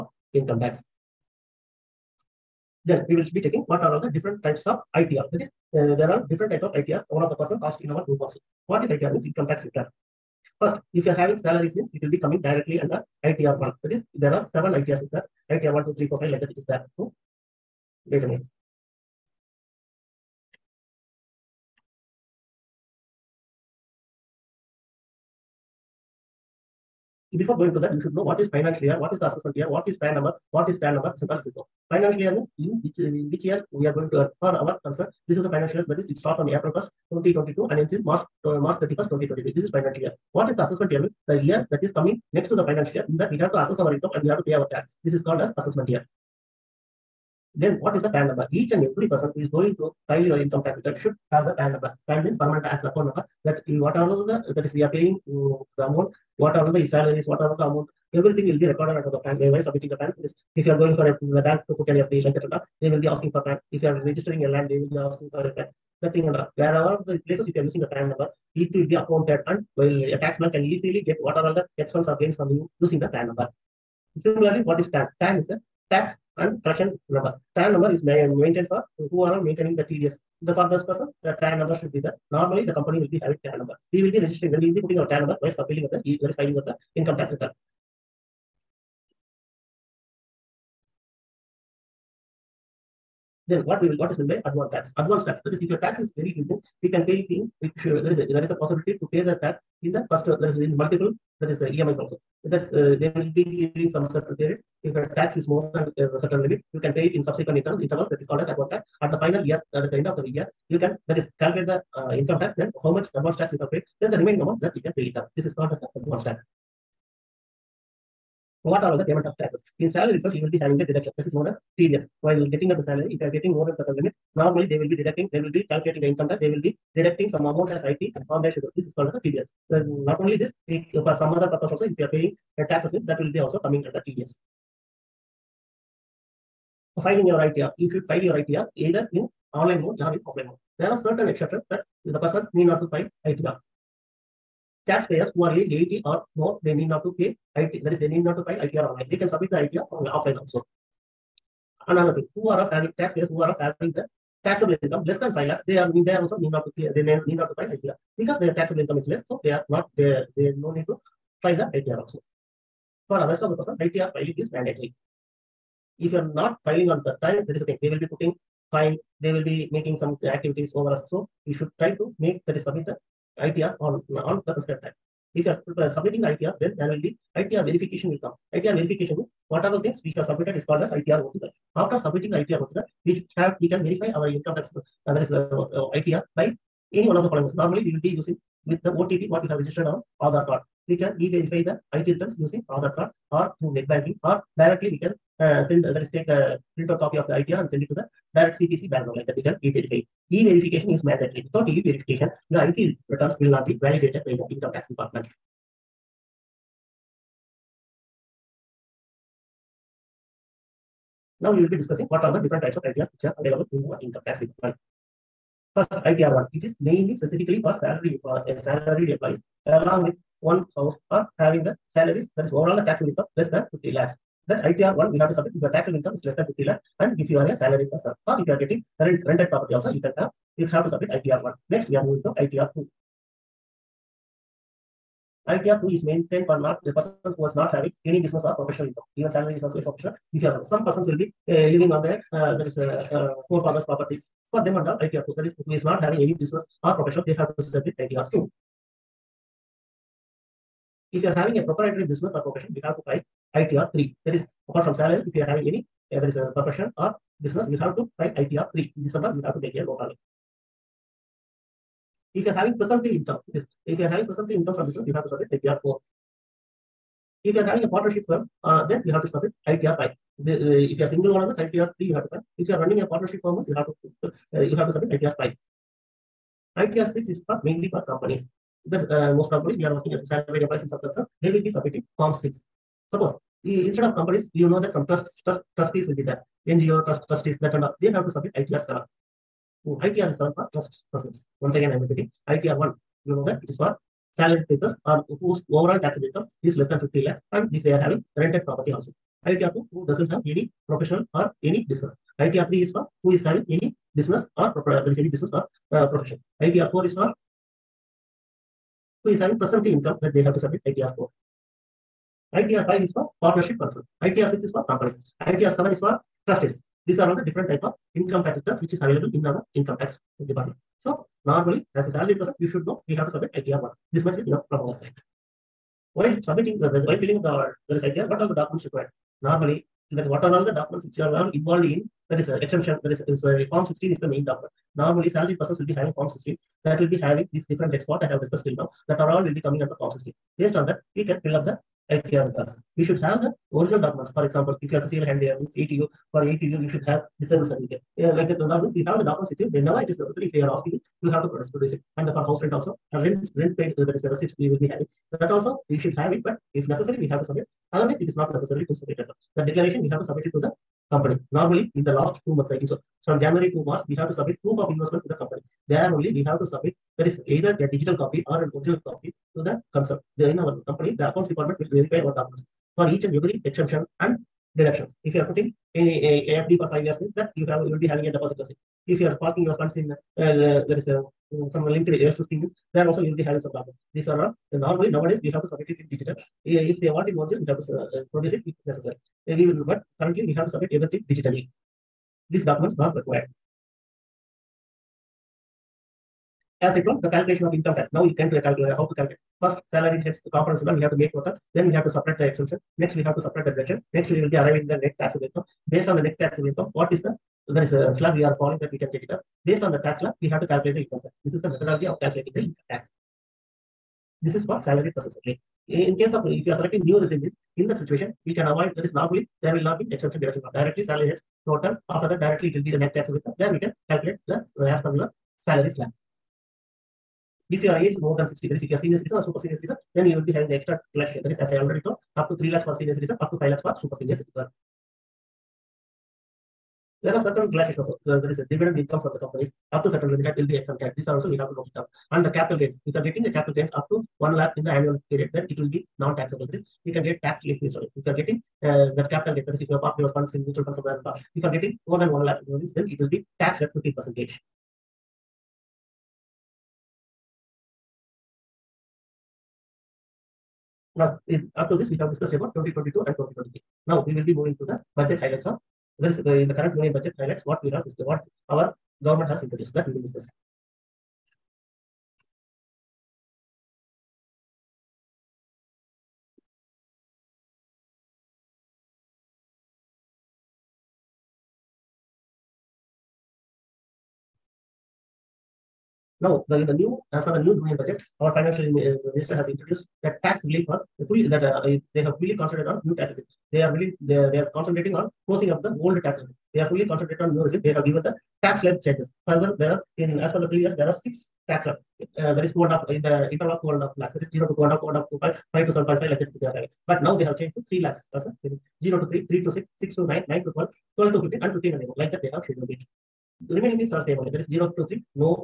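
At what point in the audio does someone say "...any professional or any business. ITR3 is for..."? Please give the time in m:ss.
5:00.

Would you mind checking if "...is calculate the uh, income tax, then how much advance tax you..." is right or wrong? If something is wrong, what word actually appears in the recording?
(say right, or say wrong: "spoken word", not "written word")
right.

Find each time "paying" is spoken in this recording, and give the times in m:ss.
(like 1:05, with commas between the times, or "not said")
0:54, 2:12.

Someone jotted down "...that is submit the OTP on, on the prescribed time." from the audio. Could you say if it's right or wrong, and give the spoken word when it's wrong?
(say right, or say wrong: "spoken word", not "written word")
wrong: "ITR", not "OTP".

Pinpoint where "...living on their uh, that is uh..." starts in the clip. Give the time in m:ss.
4:01.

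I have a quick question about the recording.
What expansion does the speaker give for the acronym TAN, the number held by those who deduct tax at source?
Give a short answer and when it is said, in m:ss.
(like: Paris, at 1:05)
tax and collection number, at 1:15.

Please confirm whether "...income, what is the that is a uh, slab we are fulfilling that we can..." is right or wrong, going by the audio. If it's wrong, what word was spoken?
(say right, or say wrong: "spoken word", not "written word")
wrong: "calling", not "fulfilling".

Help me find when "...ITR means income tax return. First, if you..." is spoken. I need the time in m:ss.
0:08.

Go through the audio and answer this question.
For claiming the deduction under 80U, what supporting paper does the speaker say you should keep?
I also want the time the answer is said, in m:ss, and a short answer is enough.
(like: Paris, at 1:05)
disabled certificate, at 5:47.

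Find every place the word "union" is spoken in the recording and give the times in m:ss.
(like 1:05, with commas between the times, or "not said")
7:46, 8:07.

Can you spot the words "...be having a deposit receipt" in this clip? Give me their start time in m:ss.
6:17.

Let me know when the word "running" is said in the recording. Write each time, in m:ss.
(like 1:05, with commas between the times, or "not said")
4:32.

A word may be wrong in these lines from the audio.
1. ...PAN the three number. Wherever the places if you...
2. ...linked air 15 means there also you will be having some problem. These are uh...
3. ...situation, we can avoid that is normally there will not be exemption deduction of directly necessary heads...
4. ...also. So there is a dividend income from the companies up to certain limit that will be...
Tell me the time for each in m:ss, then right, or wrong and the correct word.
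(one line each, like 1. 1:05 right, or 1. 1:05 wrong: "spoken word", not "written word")
1. 1:05 right
2. 6:21 right
3. 6:58 wrong: "salary", not "necessary"
4. 7:18 right.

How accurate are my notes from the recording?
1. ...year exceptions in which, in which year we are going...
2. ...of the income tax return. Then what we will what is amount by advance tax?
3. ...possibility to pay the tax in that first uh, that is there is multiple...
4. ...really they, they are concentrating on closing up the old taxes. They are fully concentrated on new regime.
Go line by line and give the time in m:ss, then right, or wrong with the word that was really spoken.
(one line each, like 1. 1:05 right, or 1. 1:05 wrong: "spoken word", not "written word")
1. 0:32 wrong: "means", not "exceptions"
2. 1:26 wrong: "meant", not "amount"
3. 1:38 right
4. 8:13 right.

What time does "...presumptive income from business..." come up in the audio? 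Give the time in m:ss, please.
4:24.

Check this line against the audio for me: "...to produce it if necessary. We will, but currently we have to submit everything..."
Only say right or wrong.
right.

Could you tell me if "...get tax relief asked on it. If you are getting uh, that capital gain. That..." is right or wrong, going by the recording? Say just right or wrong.
wrong.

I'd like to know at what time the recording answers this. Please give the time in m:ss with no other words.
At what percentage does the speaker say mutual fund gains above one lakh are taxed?
7:33.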